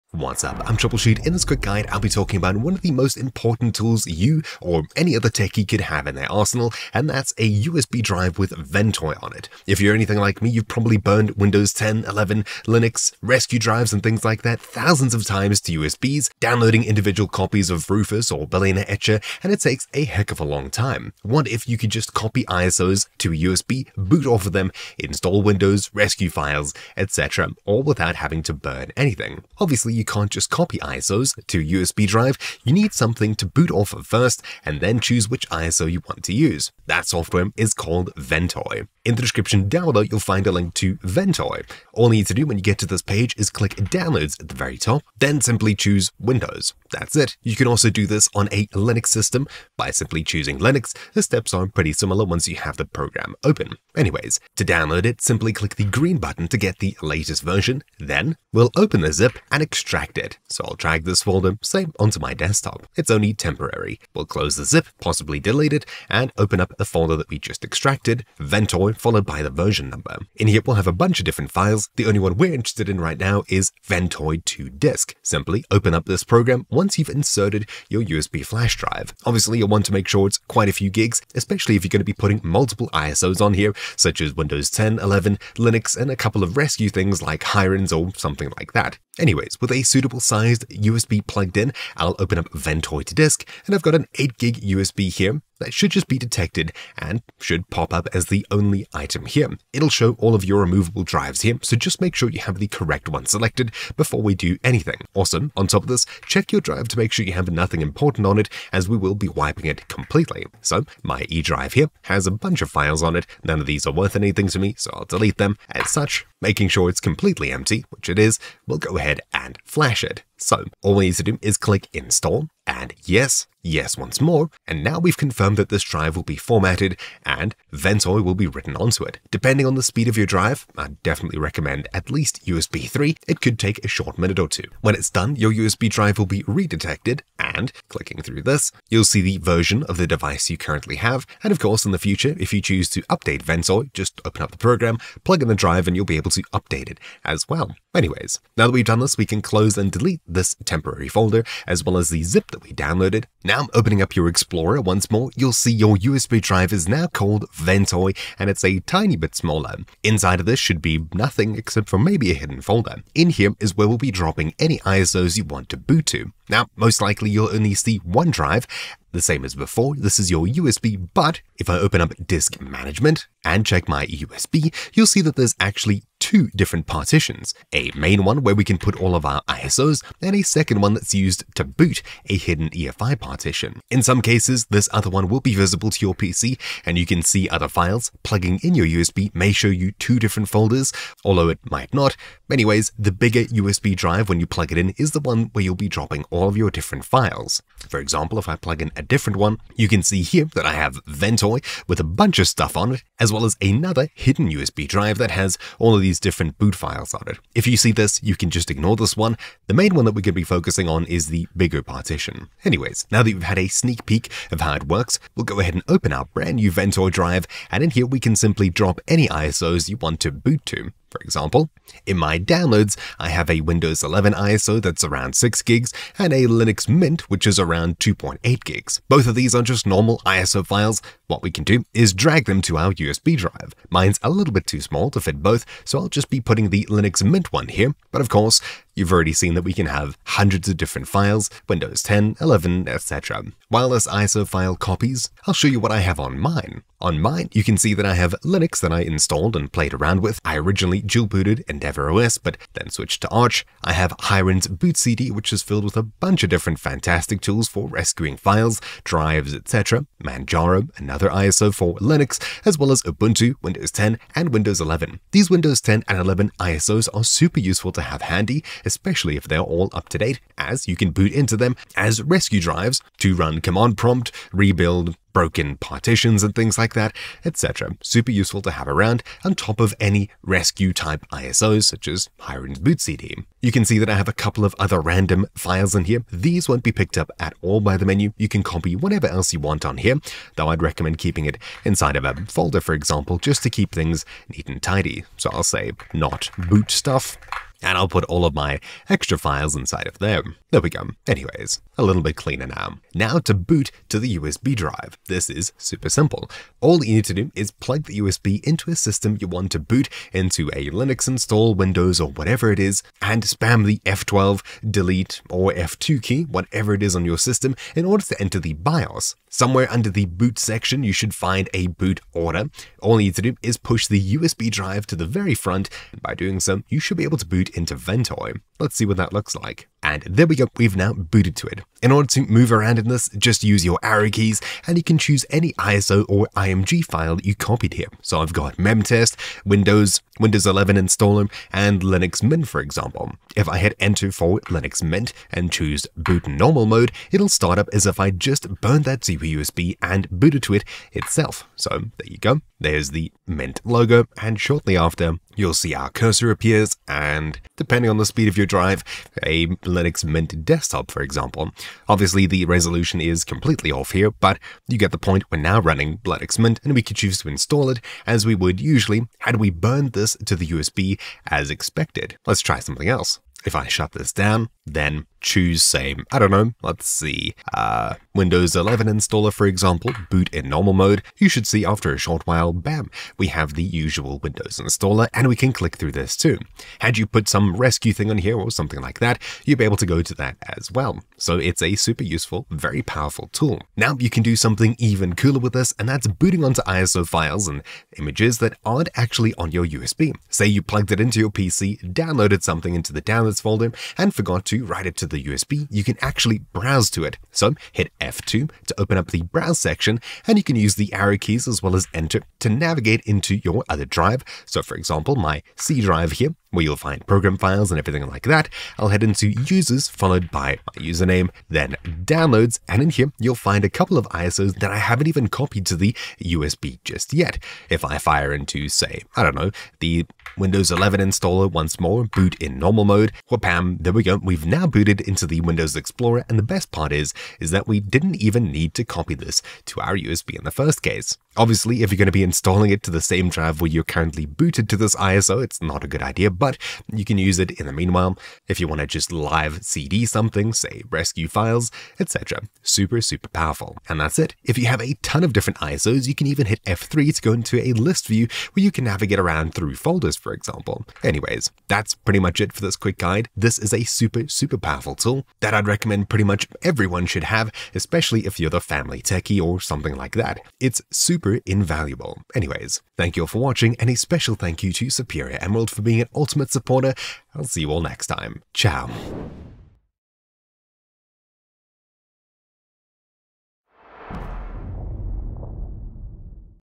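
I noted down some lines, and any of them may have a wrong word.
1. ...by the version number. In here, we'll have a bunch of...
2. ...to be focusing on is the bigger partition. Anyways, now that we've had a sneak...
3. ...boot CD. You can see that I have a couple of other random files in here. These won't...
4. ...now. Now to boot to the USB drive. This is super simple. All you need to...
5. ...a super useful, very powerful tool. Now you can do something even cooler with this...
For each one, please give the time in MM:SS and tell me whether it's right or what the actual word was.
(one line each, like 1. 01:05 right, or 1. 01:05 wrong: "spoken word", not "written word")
1. 01:09 right
2. 03:30 right
3. 04:42 right
4. 05:02 right
5. 06:31 right.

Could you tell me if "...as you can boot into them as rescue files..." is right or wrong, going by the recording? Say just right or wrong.
wrong.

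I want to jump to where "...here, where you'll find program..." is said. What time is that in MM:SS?
06:56.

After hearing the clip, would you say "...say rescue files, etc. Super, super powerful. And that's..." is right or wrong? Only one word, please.
right.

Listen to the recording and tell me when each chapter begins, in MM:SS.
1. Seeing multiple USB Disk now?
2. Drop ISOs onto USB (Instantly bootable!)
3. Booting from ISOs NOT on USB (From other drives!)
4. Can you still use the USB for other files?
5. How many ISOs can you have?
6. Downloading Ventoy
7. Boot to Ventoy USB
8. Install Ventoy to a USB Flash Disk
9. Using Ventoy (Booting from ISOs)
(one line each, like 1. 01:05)
1. 02:33
2. 03:30
3. 06:30
4. 04:40
5. 04:02
6. 00:36
7. 05:02
8. 01:05
9. 05:30.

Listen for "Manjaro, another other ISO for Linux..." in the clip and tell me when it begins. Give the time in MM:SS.
04:20.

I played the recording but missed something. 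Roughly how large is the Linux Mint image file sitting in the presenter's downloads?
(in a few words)
2.8 gigs.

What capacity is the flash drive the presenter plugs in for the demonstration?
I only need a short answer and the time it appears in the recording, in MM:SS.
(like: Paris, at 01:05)
8 gig, at 01:34.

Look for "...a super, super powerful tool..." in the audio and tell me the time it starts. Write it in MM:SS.
07:43.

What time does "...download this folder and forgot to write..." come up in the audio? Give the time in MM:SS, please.
06:43.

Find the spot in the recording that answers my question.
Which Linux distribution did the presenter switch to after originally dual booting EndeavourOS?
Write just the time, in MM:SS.
04:13.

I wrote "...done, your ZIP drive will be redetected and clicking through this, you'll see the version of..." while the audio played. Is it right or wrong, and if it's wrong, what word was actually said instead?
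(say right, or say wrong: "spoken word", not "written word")
wrong: "USB", not "ZIP".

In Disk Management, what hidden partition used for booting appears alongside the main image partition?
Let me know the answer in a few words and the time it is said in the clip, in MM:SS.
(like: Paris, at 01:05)
EFI partition, at 03:02.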